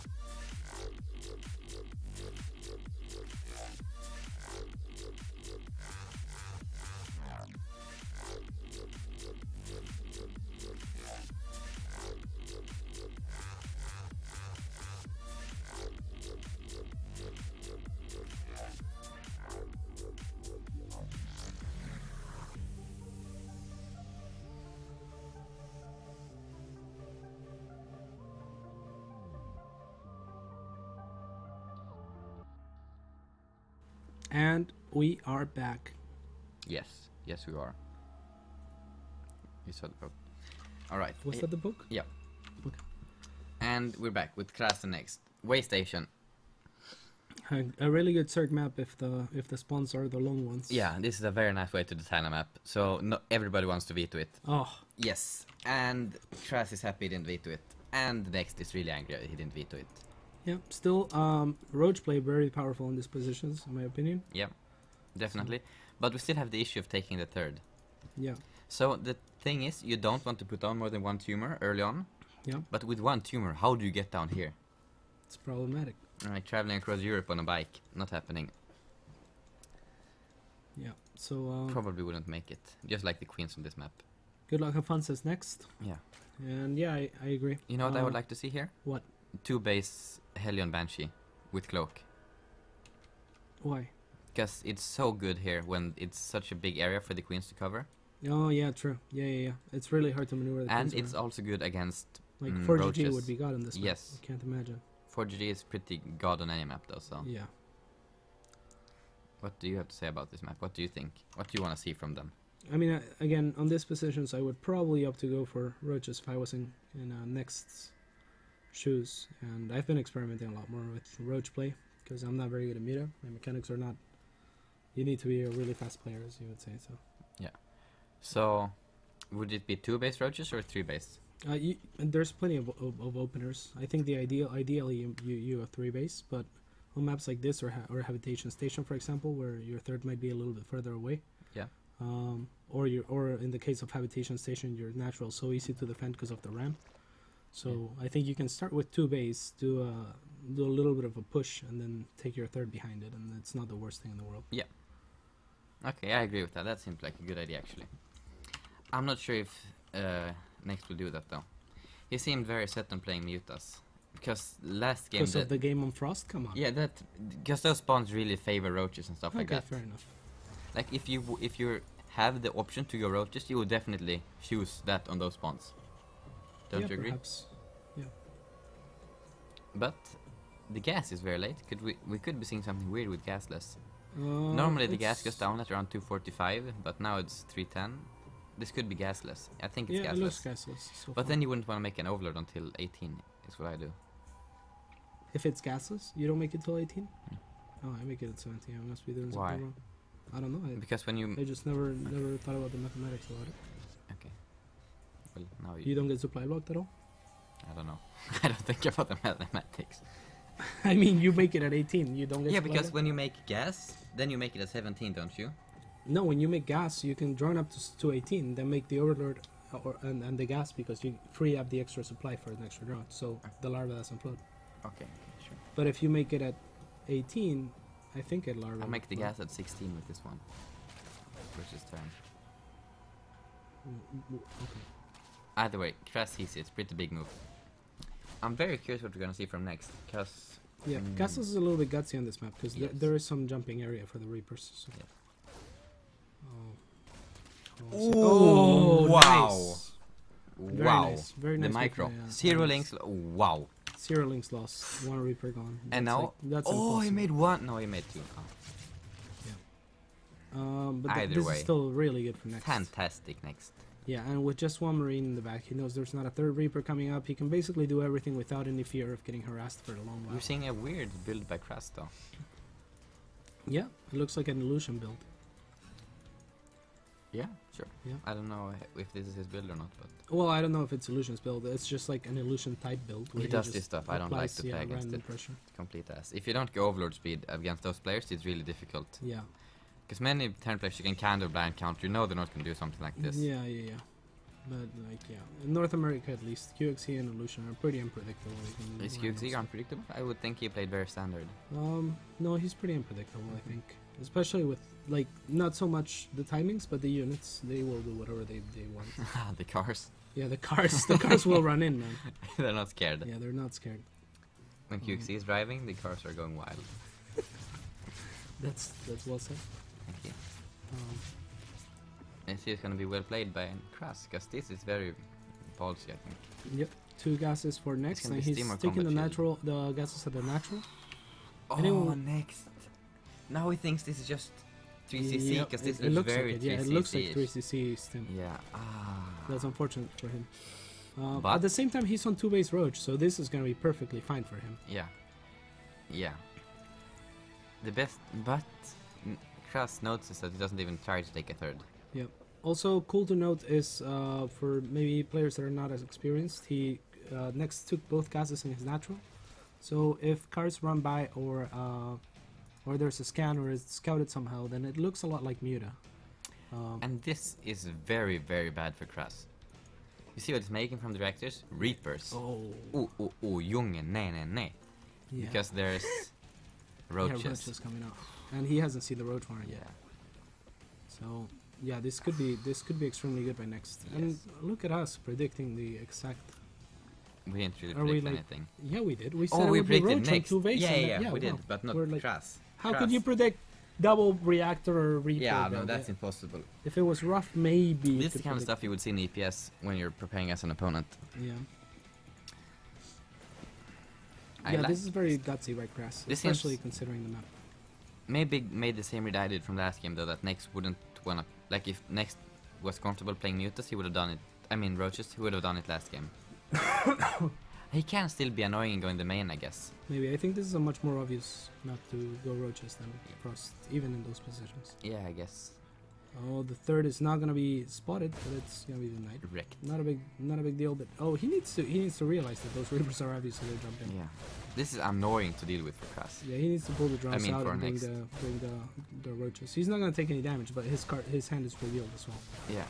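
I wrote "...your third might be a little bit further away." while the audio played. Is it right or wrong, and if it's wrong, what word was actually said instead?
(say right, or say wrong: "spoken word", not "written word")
right.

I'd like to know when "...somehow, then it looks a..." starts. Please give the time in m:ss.
6:04.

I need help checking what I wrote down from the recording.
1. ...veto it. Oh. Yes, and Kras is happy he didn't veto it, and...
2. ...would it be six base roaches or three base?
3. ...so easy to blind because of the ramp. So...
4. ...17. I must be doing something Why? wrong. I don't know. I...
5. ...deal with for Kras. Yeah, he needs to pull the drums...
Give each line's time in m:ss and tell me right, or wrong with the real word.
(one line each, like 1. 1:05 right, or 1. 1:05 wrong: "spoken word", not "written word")
1. 0:53 right
2. 2:09 wrong: "two", not "six"
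3. 2:25 wrong: "defend", not "blind"
4. 3:18 right
5. 7:15 right.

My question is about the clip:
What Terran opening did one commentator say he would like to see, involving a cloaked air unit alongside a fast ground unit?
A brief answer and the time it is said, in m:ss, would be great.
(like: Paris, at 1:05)
two base Hellion Banshee, at 1:29.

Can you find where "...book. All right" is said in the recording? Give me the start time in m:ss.
0:39.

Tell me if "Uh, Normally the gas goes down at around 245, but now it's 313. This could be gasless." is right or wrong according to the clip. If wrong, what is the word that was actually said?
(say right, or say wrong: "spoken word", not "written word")
wrong: "310", not "313".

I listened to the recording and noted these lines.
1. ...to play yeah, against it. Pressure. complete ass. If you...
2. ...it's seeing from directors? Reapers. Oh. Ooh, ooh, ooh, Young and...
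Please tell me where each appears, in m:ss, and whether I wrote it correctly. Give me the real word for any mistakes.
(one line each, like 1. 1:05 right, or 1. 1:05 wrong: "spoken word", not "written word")
1. 4:44 right
2. 6:10 wrong: "making", not "seeing".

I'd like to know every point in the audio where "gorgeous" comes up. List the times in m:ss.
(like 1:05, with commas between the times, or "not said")
not said.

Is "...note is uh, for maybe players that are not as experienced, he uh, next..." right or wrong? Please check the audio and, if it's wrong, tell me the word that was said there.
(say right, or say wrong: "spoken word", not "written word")
right.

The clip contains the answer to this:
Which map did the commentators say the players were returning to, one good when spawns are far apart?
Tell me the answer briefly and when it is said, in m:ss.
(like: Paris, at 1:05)
Waystation, at 0:45.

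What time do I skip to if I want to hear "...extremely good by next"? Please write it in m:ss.
6:23.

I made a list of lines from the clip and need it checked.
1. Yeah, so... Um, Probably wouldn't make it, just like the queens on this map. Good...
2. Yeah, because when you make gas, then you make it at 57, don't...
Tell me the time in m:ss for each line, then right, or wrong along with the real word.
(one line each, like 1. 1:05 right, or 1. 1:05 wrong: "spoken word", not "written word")
1. 1:20 right
2. 3:32 wrong: "17", not "57".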